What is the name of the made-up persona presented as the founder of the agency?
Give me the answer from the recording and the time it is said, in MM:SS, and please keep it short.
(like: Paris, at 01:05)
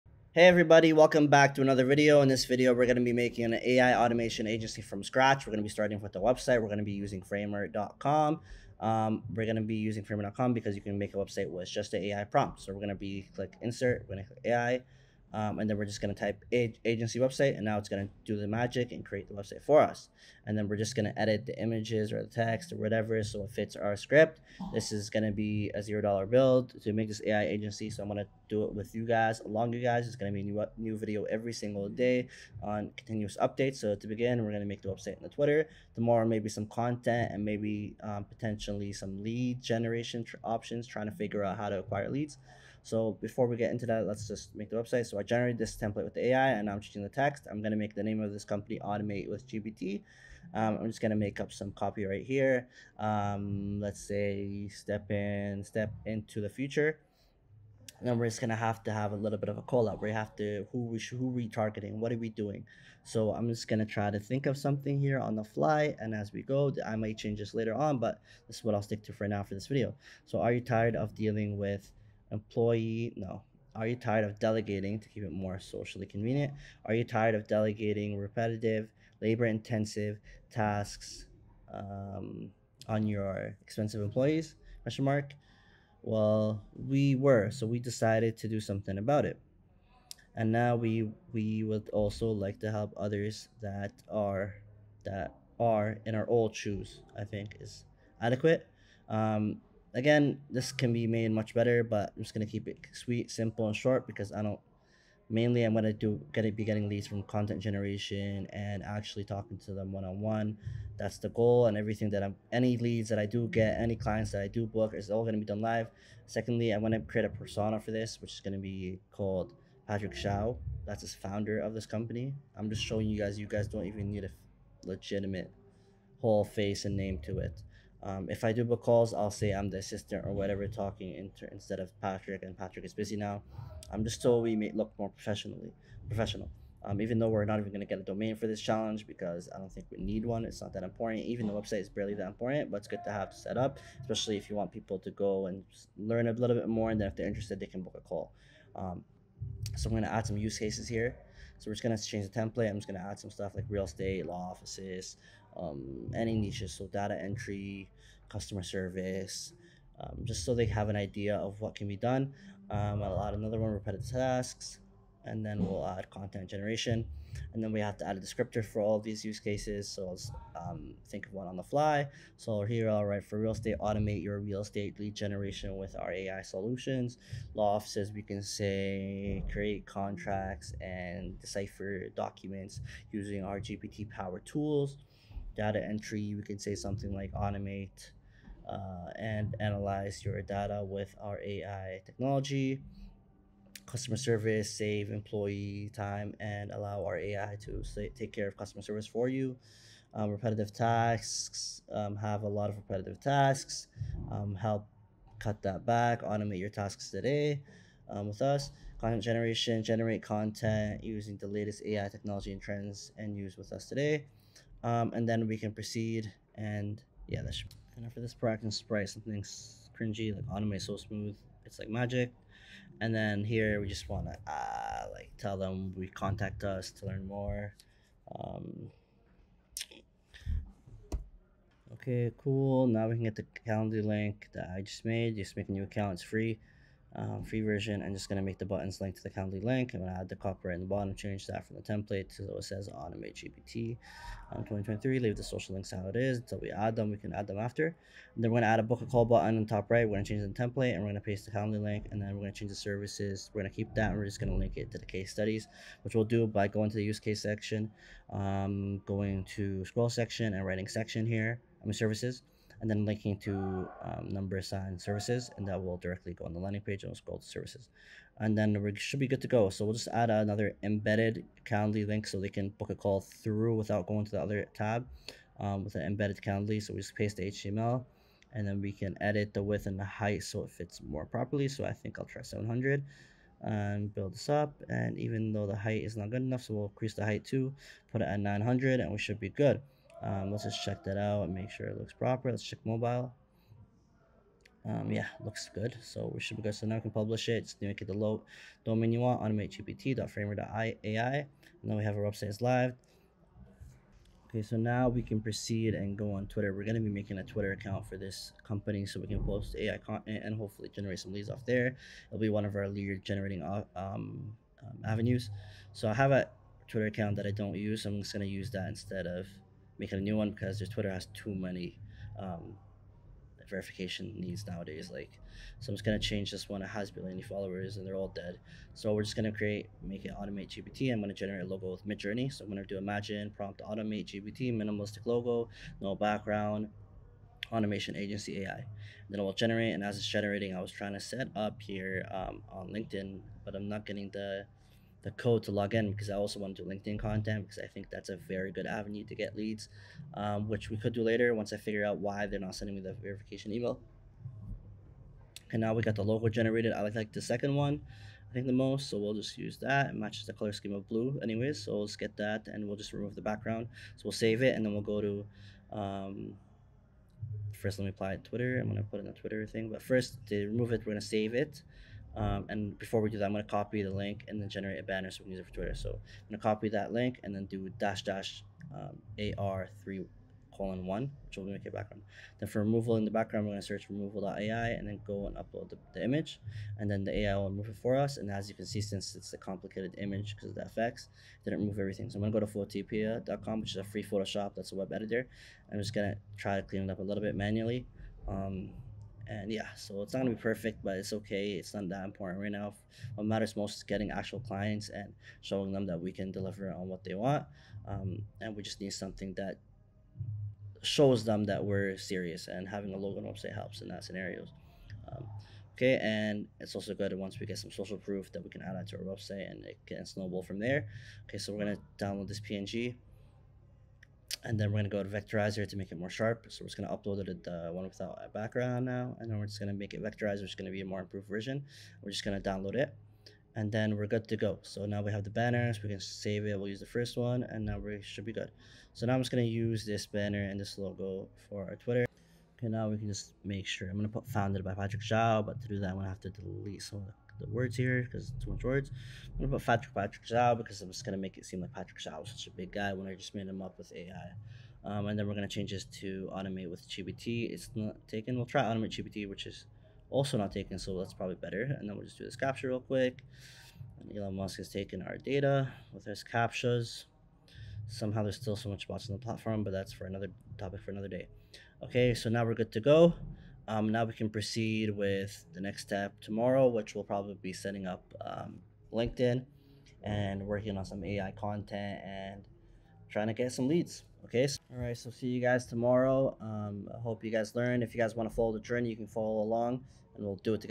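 Patrick Shao, at 01:59.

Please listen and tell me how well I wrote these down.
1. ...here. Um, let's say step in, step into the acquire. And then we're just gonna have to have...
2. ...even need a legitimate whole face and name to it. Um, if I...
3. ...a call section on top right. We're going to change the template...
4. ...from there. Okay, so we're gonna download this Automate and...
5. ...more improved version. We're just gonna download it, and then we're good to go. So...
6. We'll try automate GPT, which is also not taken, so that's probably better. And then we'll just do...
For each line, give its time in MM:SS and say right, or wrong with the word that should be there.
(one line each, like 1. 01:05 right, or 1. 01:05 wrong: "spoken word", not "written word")
1. 00:52 wrong: "future", not "acquire"
2. 02:03 right
3. 04:09 wrong: "button", not "section"
4. 07:00 wrong: "PNG", not "Automate"
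5. 07:11 right
6. 07:38 right.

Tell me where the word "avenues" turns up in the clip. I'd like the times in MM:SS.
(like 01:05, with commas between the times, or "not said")
05:15, 05:48.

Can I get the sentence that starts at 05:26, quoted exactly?
It has barely any followers, and they're all dead.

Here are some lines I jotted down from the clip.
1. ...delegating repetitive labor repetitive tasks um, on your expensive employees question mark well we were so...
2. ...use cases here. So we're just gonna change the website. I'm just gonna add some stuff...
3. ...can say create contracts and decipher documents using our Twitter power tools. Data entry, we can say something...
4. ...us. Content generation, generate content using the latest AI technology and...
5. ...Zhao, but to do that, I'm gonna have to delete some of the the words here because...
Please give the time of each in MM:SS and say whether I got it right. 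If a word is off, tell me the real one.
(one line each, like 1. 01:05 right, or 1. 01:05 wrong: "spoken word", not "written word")
1. 01:17 wrong: "intensive", not "repetitive"
2. 02:30 wrong: "template", not "website"
3. 02:58 wrong: "GPT", not "Twitter"
4. 03:28 right
5. 07:25 right.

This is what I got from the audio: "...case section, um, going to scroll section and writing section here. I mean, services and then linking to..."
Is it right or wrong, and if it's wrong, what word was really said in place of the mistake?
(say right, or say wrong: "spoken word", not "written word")
right.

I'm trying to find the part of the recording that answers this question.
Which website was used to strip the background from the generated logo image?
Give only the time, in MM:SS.
06:24.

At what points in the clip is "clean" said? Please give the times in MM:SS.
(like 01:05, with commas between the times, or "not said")
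06:36.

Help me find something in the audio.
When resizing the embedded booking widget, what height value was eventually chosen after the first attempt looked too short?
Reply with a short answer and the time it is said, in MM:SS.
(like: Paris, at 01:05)
900, at 04:48.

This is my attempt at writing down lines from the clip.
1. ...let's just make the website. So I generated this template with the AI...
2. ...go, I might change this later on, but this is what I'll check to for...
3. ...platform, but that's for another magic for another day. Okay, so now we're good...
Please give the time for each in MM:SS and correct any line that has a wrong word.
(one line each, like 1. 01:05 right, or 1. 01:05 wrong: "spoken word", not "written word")
1. 00:44 right
2. 01:06 wrong: "stick", not "check"
3. 07:49 wrong: "topic", not "magic".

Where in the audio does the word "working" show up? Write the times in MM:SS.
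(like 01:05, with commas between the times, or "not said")
08:00.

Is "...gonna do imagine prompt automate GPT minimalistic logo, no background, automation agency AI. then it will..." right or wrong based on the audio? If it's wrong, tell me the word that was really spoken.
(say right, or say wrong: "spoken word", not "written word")
right.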